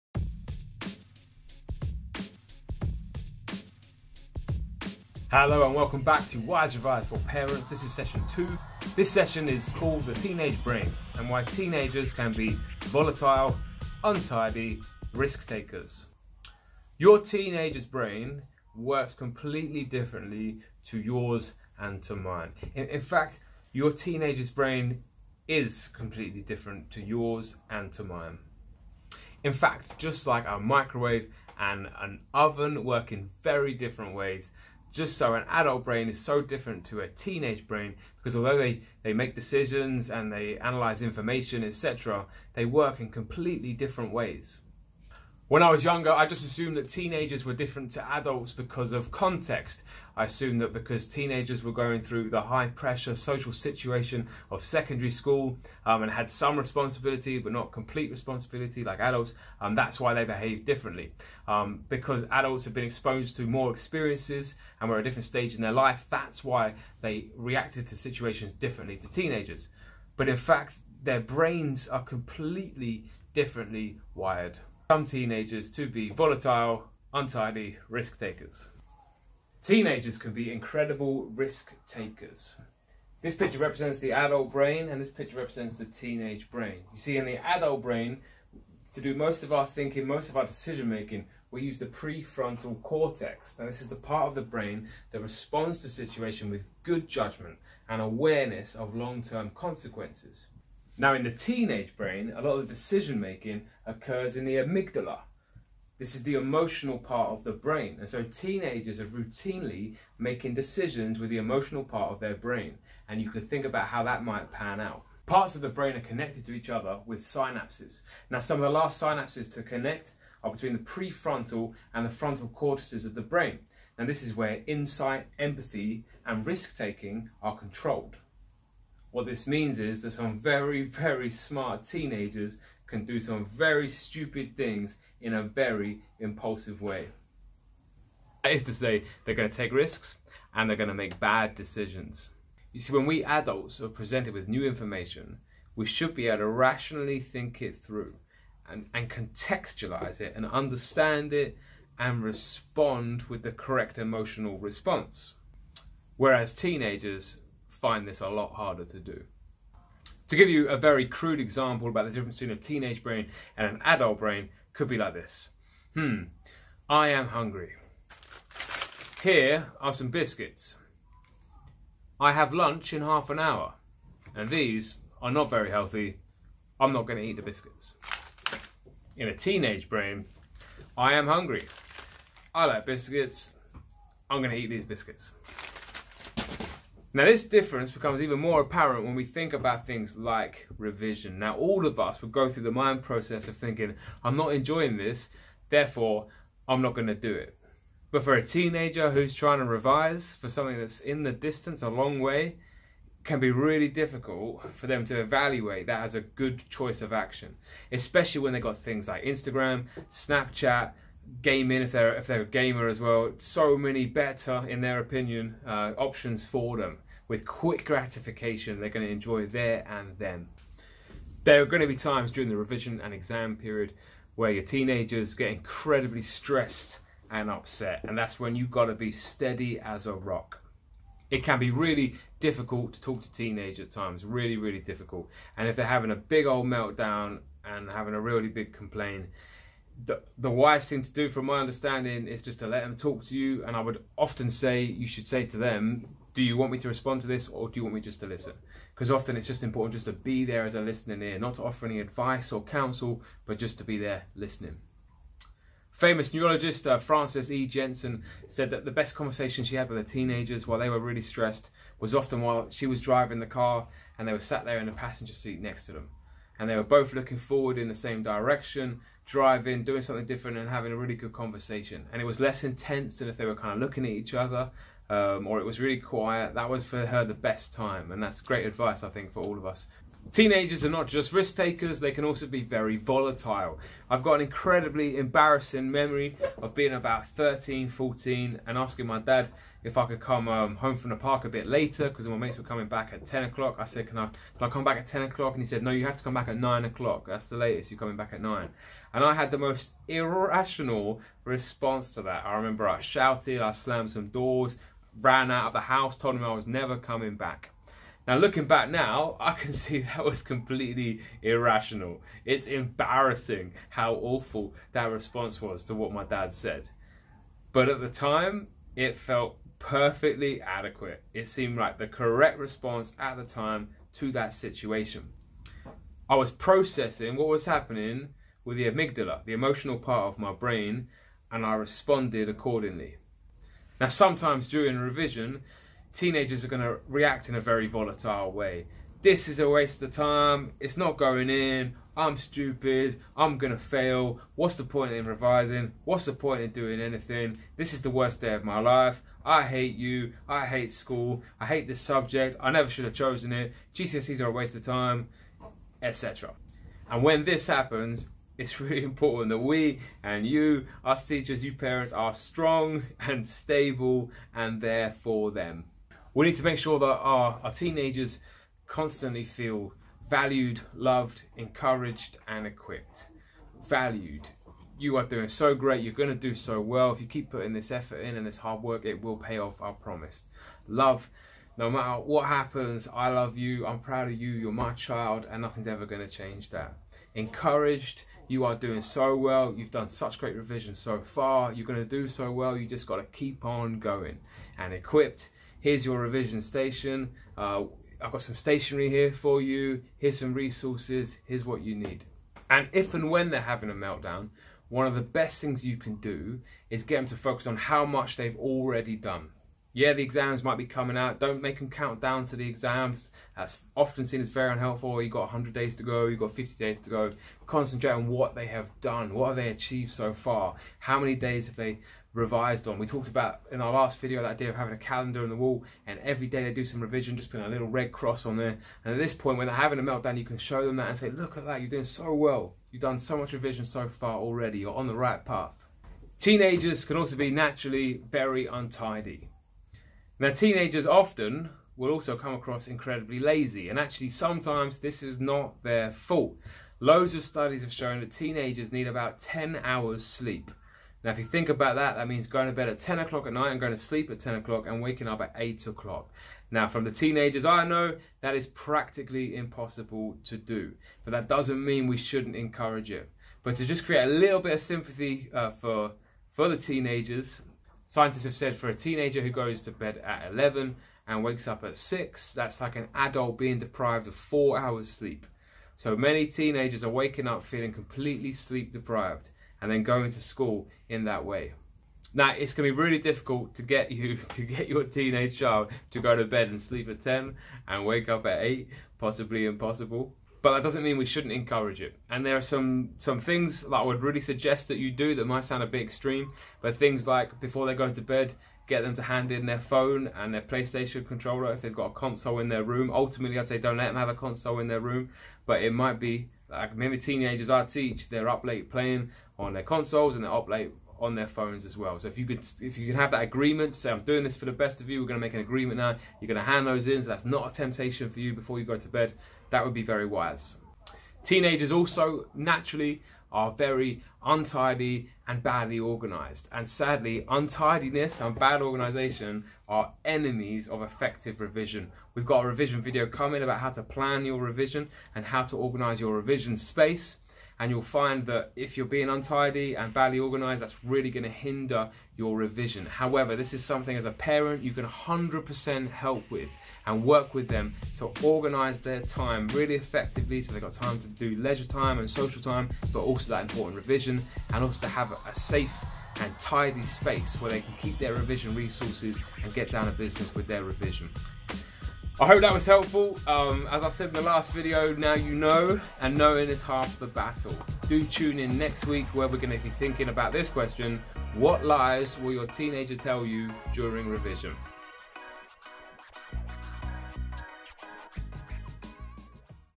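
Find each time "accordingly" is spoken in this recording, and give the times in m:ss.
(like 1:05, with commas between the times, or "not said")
5:32.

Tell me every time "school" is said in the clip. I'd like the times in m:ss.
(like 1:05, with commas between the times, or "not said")
0:55, 5:50, 8:00.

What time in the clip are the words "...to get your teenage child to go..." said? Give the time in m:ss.
8:04.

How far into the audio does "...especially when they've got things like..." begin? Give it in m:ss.
3:27.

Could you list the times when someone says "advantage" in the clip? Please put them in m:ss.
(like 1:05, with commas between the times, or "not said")
not said.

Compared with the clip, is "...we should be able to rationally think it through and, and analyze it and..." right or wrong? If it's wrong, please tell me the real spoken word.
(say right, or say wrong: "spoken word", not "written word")
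wrong: "contextualize", not "analyze".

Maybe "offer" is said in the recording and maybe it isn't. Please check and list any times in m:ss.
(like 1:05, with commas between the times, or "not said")
4:11.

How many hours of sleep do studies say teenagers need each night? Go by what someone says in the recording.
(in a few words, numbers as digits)
10 hours.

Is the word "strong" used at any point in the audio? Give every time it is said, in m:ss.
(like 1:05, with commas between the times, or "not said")
6:02.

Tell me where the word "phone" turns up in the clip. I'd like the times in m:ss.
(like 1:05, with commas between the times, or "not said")
8:19, 8:31.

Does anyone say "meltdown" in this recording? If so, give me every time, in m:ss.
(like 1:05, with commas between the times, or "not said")
3:56, 6:43, 7:10.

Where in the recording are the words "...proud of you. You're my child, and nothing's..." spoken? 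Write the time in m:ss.
6:23.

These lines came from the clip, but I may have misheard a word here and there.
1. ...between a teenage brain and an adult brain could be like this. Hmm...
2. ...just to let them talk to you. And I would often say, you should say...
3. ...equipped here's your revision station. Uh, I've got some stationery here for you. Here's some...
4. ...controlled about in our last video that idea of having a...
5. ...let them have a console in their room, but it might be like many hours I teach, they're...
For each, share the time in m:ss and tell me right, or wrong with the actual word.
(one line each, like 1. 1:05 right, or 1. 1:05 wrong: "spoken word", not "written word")
1. 2:42 right
2. 4:02 right
3. 6:34 right
4. 7:03 wrong: "talked", not "controlled"
5. 8:23 wrong: "teenagers", not "hours".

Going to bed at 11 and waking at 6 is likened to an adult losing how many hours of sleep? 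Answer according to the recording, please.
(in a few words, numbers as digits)
4 hours.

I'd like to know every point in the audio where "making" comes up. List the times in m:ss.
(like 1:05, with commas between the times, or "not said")
1:30, 1:43, 1:50.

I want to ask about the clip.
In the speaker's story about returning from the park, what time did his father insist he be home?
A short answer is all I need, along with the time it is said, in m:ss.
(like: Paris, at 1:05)
9 o'clock, at 4:56.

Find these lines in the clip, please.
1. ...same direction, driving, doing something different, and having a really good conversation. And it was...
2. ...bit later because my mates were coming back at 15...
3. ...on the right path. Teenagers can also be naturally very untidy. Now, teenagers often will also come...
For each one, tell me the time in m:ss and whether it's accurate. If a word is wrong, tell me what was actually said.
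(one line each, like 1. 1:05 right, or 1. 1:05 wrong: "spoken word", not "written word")
1. 4:27 right
2. 4:51 wrong: "10", not "15"
3. 7:14 right.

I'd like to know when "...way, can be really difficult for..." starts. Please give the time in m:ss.
3:22.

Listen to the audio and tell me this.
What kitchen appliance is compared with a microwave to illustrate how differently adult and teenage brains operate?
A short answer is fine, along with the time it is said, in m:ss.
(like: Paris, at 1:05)
Oven, at 0:32.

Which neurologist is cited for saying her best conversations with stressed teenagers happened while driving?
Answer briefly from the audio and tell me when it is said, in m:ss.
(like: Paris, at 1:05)
Frances E. Jensen, at 4:16.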